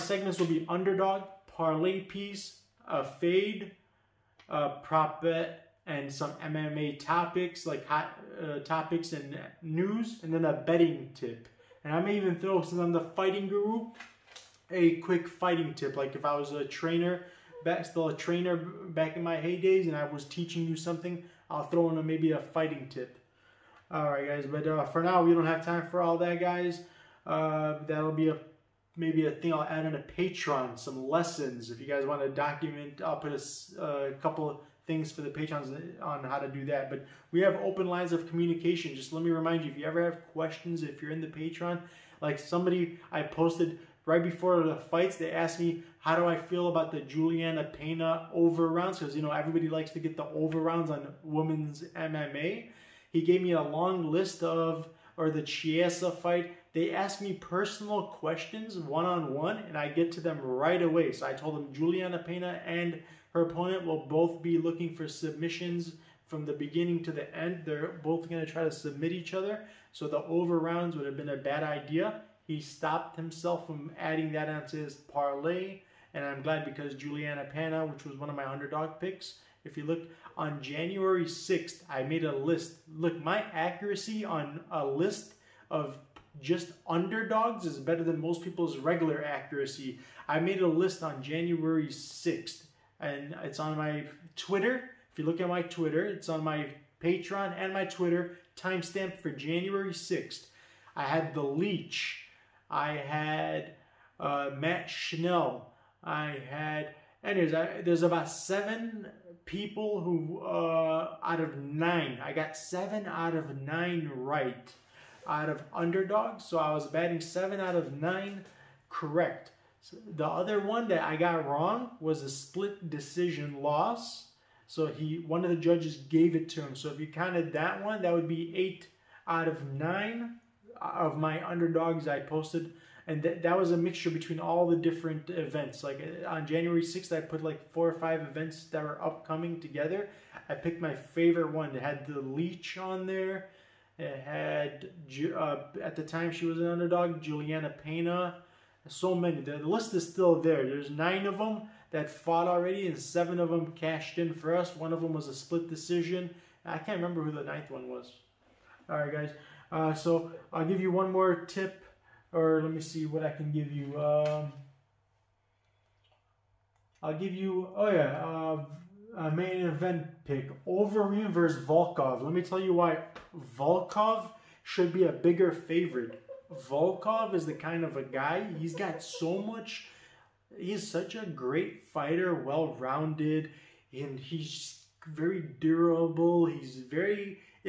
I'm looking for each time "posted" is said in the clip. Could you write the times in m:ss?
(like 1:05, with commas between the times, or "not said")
0:43, 2:12.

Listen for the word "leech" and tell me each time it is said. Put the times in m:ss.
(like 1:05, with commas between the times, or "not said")
1:41, 2:22.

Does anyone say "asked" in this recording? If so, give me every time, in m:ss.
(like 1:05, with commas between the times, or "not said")
0:45, 0:56.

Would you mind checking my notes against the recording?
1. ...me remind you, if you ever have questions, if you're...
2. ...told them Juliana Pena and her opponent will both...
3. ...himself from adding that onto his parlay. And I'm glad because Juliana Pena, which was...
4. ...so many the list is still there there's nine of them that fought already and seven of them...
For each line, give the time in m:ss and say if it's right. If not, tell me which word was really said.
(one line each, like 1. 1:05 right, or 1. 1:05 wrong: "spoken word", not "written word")
1. 0:39 right
2. 1:01 right
3. 1:13 right
4. 2:28 right.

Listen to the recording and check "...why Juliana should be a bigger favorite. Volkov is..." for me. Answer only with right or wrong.
wrong.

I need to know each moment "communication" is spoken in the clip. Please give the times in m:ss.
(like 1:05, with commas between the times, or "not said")
0:38.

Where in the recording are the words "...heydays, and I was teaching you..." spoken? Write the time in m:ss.
0:19.